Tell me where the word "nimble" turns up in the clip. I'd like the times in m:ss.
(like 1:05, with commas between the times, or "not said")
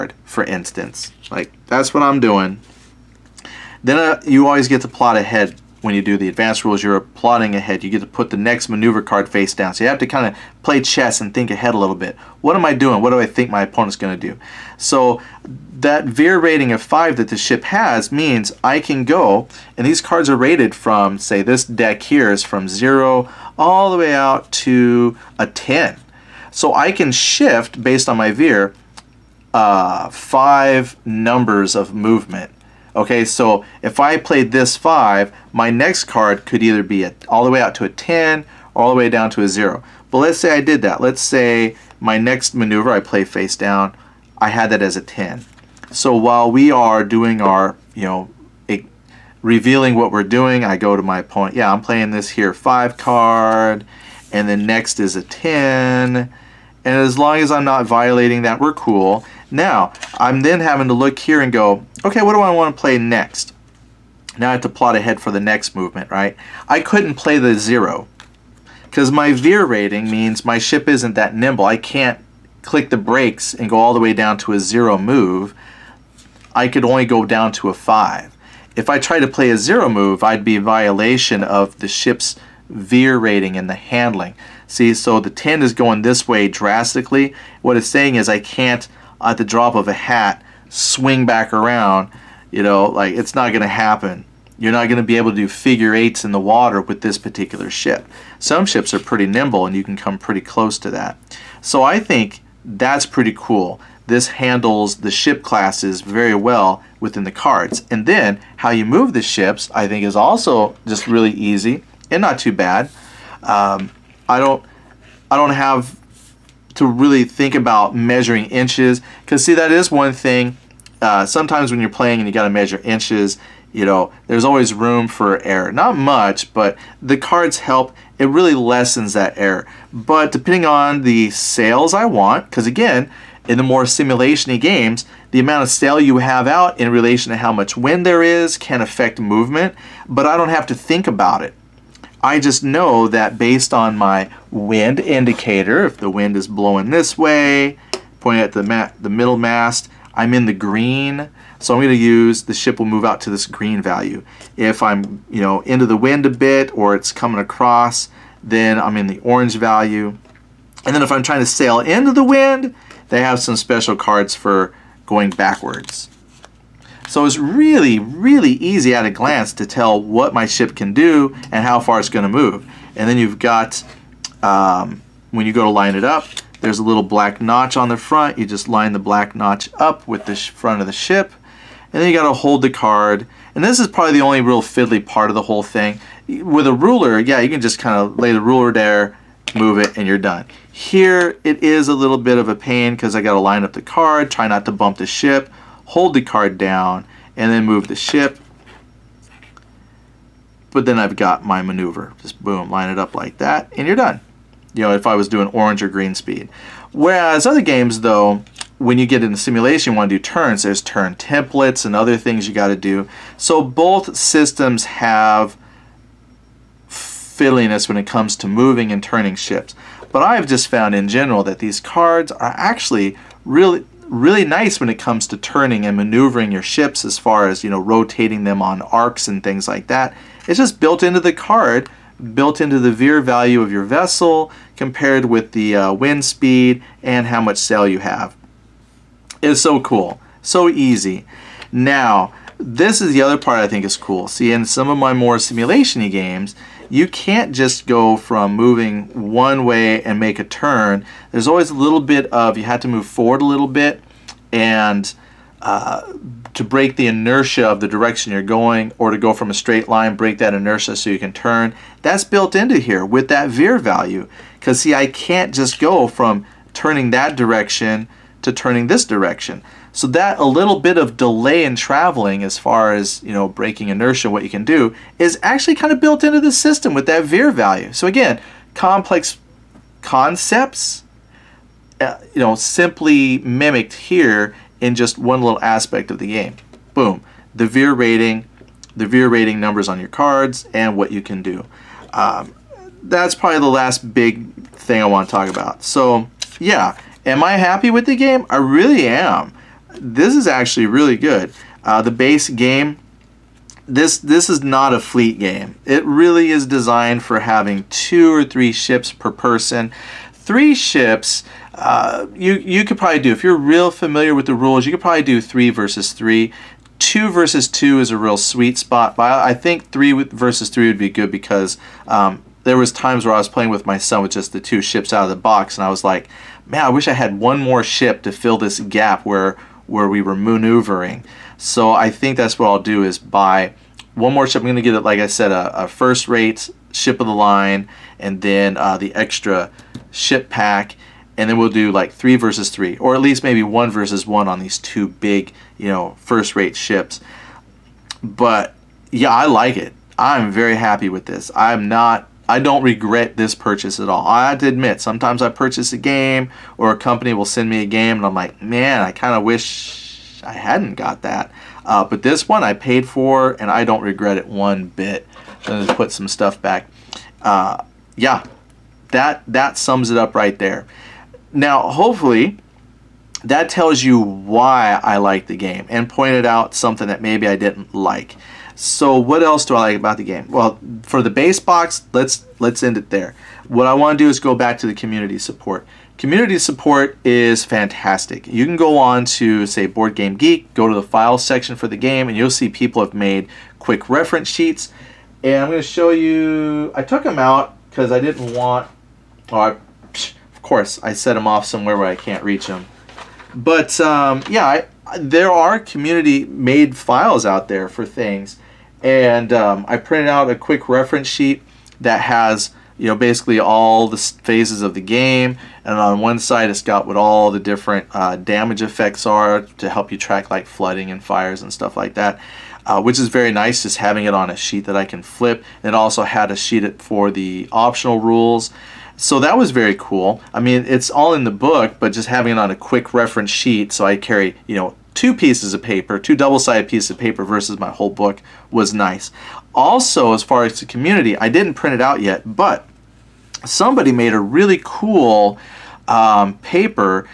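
1:11, 1:39.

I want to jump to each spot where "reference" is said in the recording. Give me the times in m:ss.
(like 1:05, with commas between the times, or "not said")
6:34, 6:50, 7:13.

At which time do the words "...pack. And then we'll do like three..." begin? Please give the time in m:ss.
5:40.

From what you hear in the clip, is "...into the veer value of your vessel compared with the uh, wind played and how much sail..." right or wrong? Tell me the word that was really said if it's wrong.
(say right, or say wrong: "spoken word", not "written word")
wrong: "speed", not "played".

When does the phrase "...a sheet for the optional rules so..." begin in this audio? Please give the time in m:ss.
7:06.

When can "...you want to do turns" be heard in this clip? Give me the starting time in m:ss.
3:29.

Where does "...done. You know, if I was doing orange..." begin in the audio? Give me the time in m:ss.
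3:23.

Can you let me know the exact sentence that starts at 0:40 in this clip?
But let's say I did that.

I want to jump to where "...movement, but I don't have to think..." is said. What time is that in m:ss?
2:19.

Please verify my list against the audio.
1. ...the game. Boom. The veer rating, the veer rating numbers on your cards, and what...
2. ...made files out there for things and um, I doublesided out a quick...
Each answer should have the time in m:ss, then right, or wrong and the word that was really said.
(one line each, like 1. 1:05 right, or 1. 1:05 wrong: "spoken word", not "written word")
1. 4:46 right
2. 6:46 wrong: "printed", not "doublesided".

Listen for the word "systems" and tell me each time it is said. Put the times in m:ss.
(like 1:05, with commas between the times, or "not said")
3:34, 4:36.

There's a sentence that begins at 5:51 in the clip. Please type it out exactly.
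I'm not I don't regret this purchase at all.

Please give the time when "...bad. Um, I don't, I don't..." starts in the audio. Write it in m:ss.
1:52.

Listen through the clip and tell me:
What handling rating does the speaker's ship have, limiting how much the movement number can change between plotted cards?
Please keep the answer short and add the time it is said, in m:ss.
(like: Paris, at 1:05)
5, at 0:16.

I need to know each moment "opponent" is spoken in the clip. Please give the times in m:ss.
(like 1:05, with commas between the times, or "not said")
0:13, 0:51.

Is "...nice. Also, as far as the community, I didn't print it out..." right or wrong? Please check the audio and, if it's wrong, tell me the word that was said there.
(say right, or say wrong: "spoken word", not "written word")
right.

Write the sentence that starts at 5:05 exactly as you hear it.
It really is designed for having two or three ships per person.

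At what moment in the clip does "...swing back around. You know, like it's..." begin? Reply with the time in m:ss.
1:30.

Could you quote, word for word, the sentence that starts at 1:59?
Because see, that is one thing.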